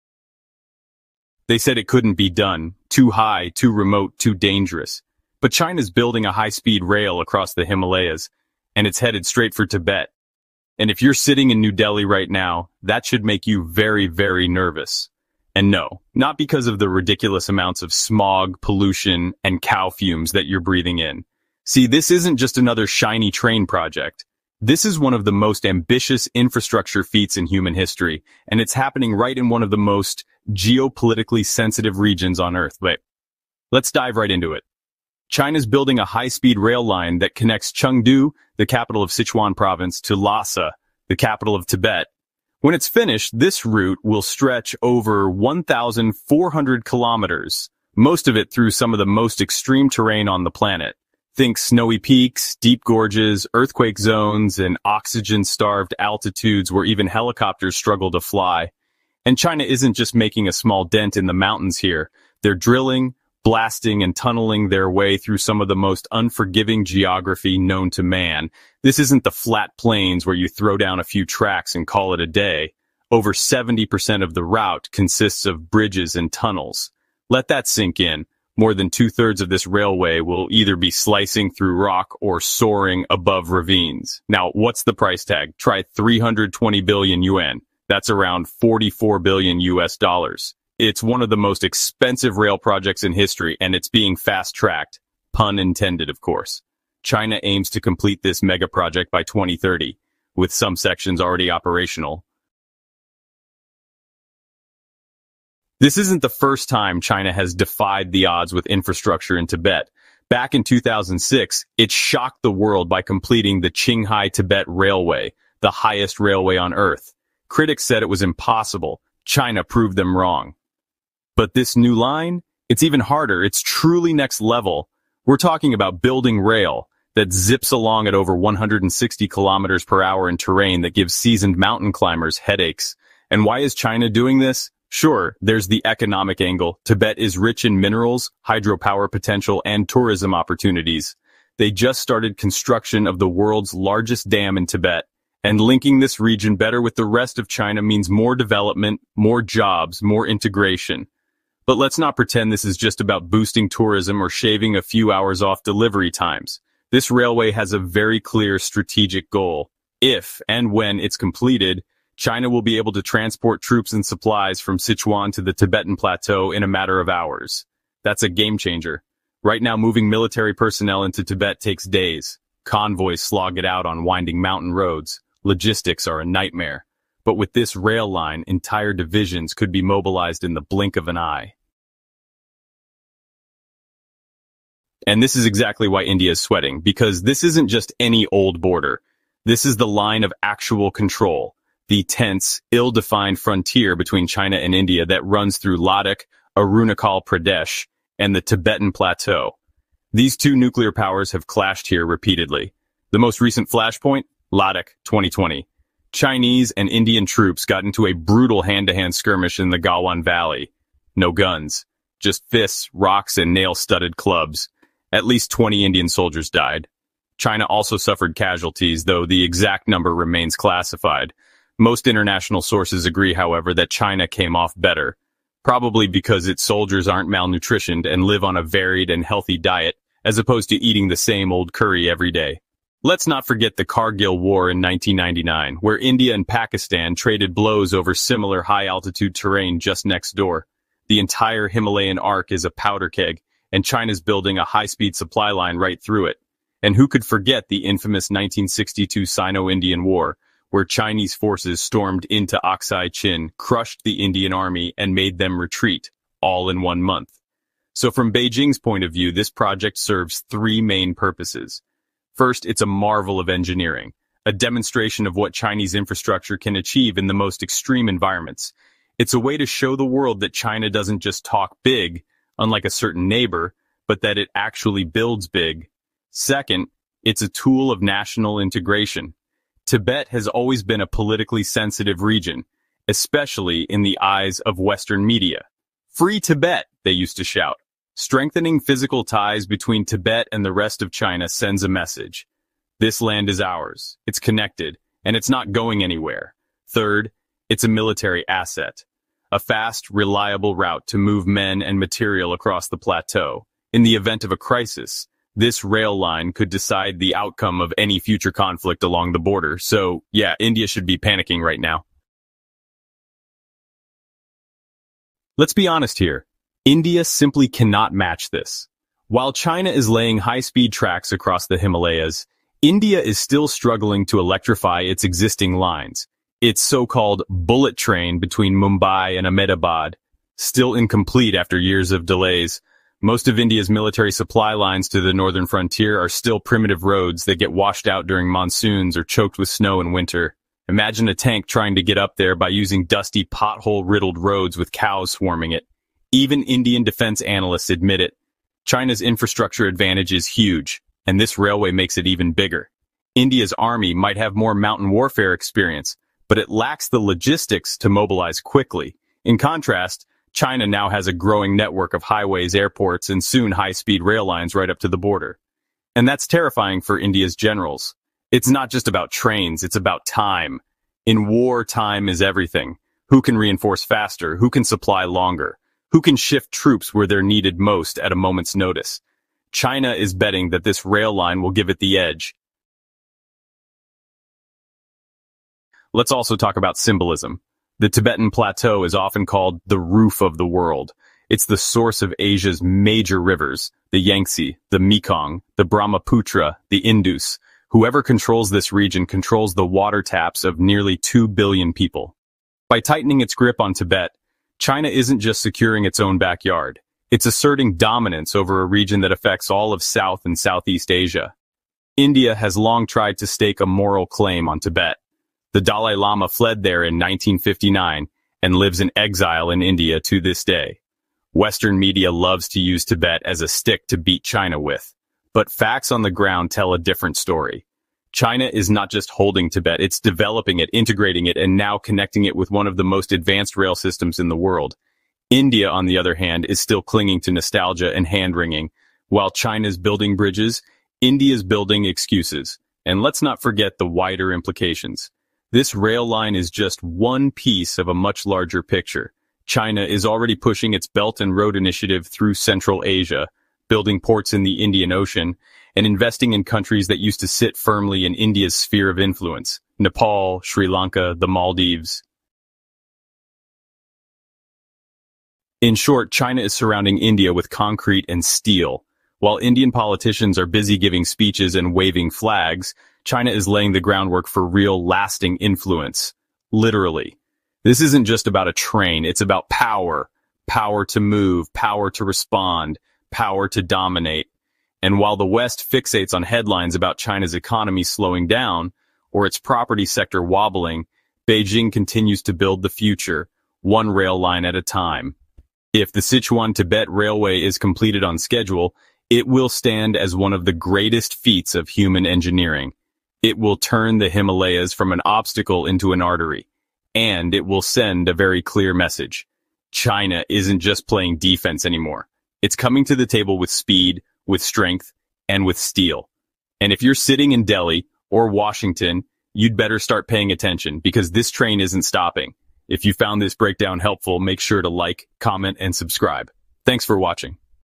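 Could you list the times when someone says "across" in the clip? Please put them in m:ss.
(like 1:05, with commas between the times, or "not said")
0:07, 5:02, 5:21.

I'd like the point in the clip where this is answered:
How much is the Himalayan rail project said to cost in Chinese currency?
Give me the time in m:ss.
1:25.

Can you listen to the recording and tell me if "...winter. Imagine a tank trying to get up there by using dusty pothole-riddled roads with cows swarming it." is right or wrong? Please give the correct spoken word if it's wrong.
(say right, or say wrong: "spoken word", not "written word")
right.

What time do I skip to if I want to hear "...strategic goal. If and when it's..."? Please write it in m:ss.
2:38.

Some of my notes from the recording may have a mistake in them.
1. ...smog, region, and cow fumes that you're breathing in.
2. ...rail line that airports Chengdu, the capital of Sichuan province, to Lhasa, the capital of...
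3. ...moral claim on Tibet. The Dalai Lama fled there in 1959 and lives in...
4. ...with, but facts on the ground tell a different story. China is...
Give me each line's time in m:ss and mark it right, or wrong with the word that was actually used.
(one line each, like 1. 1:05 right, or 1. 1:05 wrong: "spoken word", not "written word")
1. 0:17 wrong: "pollution", not "region"
2. 0:36 wrong: "connects", not "airports"
3. 6:53 right
4. 7:04 right.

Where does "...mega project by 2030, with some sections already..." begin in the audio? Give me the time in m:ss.
1:38.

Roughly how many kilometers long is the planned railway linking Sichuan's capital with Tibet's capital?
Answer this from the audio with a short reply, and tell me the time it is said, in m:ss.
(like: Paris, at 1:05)
over 1,400 kilometers, at 0:44.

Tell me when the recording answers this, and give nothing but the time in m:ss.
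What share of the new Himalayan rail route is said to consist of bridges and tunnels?
1:13.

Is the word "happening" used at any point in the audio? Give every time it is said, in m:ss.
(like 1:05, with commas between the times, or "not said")
0:28.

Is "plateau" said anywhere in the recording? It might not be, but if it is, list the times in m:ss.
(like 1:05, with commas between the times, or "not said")
2:45, 3:18, 5:02, 6:28.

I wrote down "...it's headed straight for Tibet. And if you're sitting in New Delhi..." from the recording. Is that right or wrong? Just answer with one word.
right.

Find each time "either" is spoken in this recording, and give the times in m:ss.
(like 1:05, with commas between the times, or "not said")
1:20.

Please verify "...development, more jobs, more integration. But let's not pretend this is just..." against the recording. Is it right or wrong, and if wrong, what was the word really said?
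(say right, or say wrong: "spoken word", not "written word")
right.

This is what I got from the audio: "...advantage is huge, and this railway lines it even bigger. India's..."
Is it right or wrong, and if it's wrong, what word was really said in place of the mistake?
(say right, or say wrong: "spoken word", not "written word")
wrong: "makes", not "lines".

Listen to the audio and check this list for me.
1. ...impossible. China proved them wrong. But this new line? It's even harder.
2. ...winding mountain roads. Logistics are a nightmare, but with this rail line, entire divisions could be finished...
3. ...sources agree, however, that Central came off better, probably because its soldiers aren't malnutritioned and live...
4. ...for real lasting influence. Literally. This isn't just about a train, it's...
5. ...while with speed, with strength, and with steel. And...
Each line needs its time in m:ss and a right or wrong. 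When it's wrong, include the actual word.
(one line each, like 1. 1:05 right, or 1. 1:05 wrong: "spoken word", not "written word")
1. 1:58 right
2. 2:54 wrong: "mobilized", not "finished"
3. 3:42 wrong: "China", not "Central"
4. 7:54 right
5. 8:33 wrong: "table", not "while".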